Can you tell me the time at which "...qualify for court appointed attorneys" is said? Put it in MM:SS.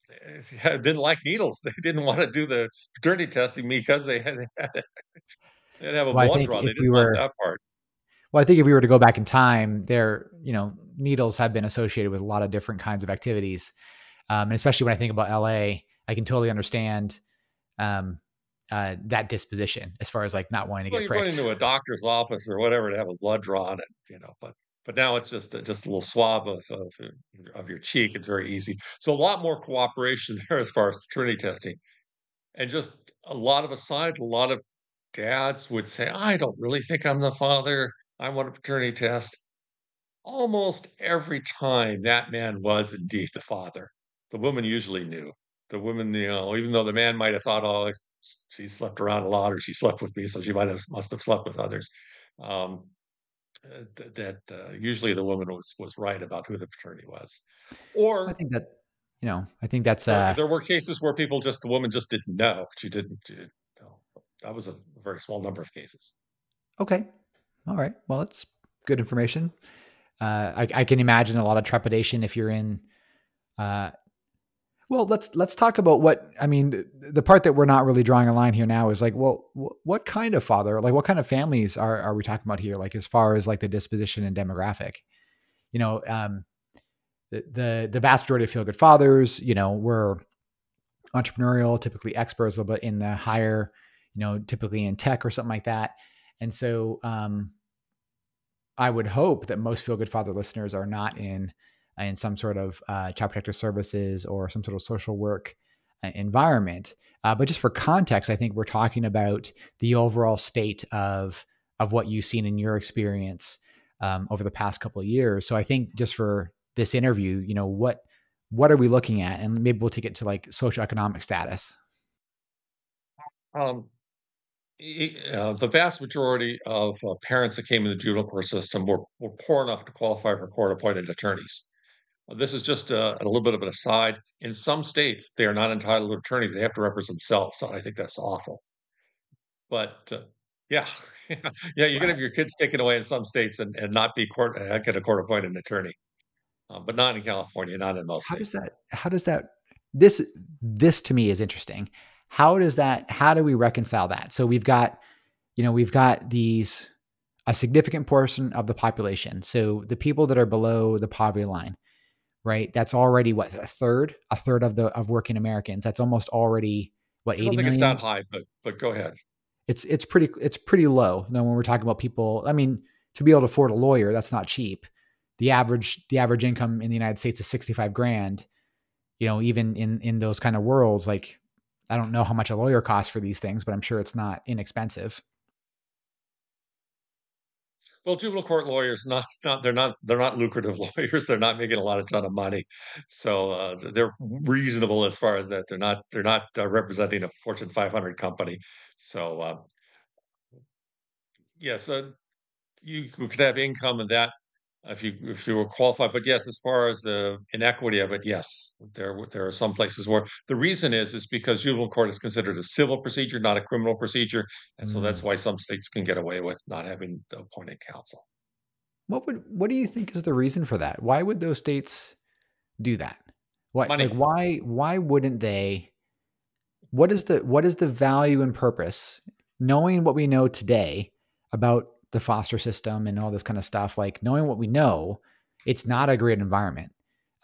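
02:09.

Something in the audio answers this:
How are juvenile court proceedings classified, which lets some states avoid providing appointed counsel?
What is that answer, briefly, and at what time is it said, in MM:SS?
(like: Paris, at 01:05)
civil procedure, at 03:32.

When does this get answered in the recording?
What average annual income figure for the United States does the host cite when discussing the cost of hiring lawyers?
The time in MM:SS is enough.
02:57.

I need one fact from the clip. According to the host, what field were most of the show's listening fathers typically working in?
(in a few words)
tech.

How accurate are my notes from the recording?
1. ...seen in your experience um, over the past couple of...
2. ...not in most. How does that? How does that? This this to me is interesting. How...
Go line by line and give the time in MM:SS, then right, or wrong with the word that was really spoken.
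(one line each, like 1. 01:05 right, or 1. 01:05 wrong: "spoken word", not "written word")
1. 01:52 right
2. 02:27 right.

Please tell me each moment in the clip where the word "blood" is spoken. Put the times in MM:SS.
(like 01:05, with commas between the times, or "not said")
00:06, 00:23.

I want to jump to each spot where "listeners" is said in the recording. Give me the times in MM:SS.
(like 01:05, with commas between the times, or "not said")
01:40.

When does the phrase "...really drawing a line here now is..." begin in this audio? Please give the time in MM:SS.
01:17.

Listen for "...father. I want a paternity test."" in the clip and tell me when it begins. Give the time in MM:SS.
00:37.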